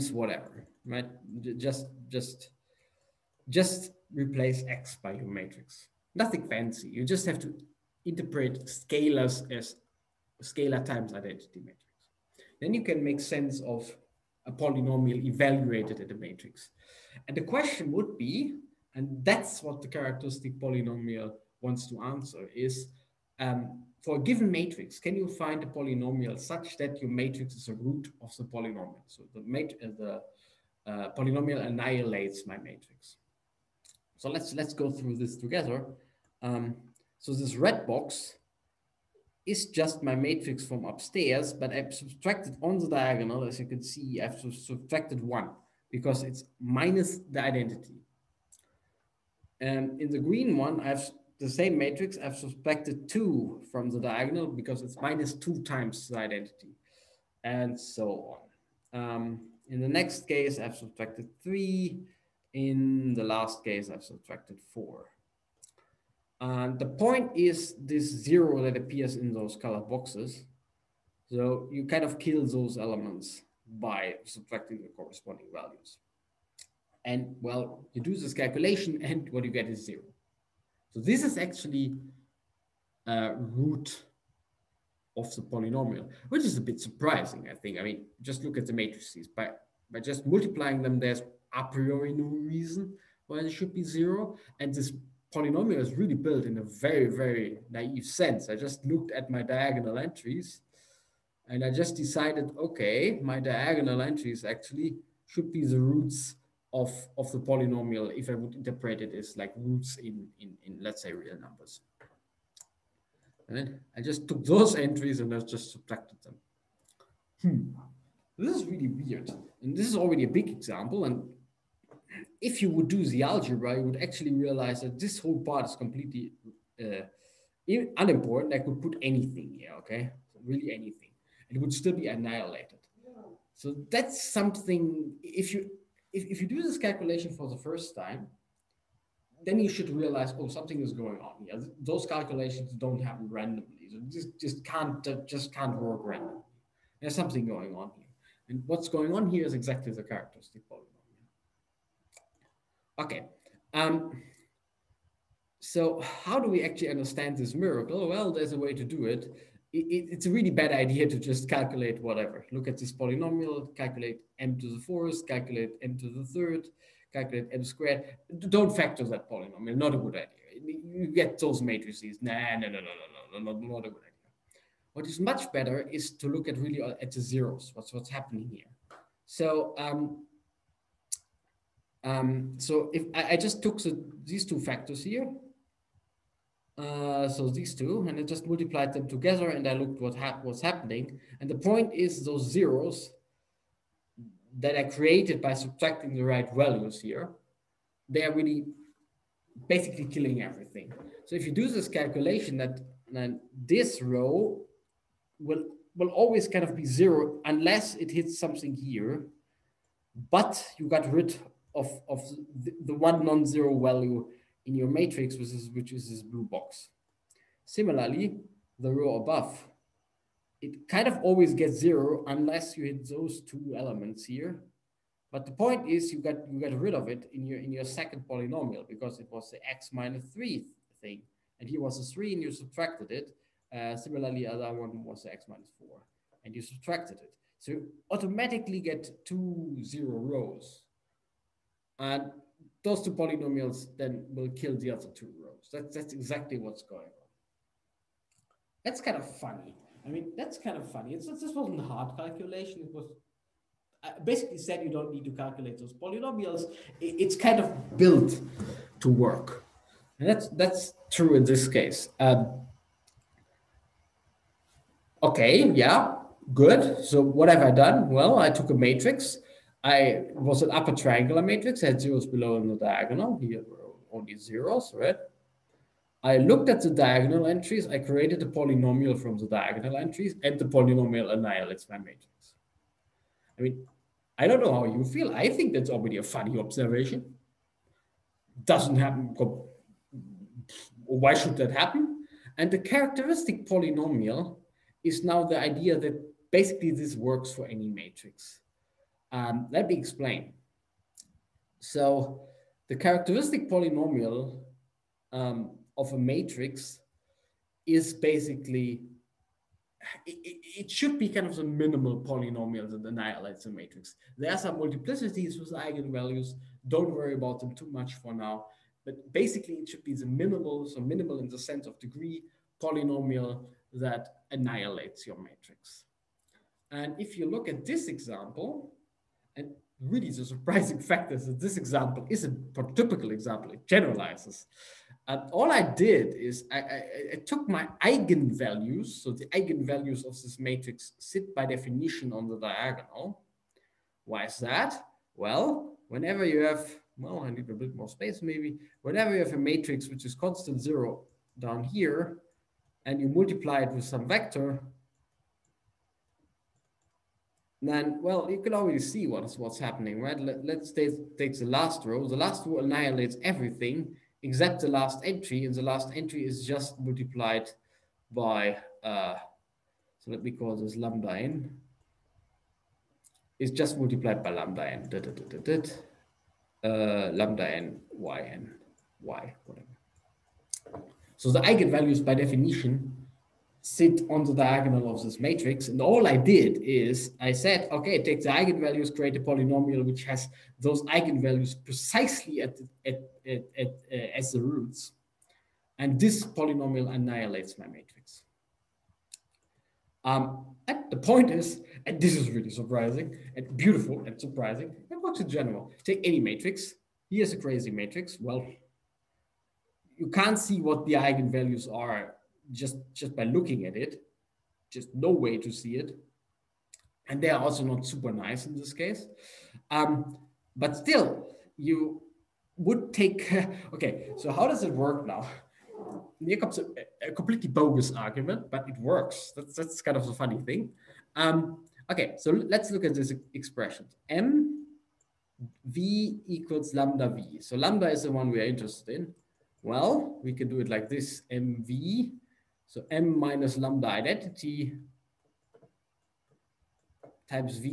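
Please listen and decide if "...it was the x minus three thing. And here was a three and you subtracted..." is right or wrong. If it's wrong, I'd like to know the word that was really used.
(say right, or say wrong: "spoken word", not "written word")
right.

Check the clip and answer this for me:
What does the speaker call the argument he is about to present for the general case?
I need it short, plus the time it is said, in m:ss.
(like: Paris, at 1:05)
completely bogus, at 7:07.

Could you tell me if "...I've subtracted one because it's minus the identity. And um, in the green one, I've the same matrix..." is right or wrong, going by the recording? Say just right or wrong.
right.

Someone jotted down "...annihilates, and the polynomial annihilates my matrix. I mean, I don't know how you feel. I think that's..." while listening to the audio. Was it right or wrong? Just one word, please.
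wrong.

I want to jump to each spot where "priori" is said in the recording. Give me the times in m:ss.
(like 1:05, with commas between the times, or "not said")
1:31.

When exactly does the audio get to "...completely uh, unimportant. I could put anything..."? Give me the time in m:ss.
2:05.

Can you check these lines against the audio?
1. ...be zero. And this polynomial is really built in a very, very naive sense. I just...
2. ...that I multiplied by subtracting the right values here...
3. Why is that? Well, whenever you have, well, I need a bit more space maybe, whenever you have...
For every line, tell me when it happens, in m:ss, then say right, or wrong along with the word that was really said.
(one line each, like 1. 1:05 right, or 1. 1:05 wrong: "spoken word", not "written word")
1. 1:33 right
2. 3:14 wrong: "created", not "multiplied"
3. 5:44 right.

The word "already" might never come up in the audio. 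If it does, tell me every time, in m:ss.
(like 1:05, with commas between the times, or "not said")
1:59, 4:45, 5:58.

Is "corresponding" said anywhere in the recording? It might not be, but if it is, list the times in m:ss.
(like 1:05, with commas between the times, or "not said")
1:14.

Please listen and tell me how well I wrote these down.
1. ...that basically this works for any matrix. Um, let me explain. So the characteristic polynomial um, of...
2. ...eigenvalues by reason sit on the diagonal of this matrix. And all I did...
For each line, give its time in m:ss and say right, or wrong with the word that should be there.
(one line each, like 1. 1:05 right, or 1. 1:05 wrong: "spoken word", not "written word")
1. 4:55 right
2. 6:21 wrong: "definition", not "reason".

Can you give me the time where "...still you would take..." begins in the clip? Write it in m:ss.
7:00.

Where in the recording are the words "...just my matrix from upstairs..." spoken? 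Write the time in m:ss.
0:39.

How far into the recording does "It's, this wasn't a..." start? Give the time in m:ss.
4:11.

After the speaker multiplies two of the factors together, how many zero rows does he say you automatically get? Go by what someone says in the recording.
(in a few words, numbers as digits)
2.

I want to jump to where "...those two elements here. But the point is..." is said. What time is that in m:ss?
3:43.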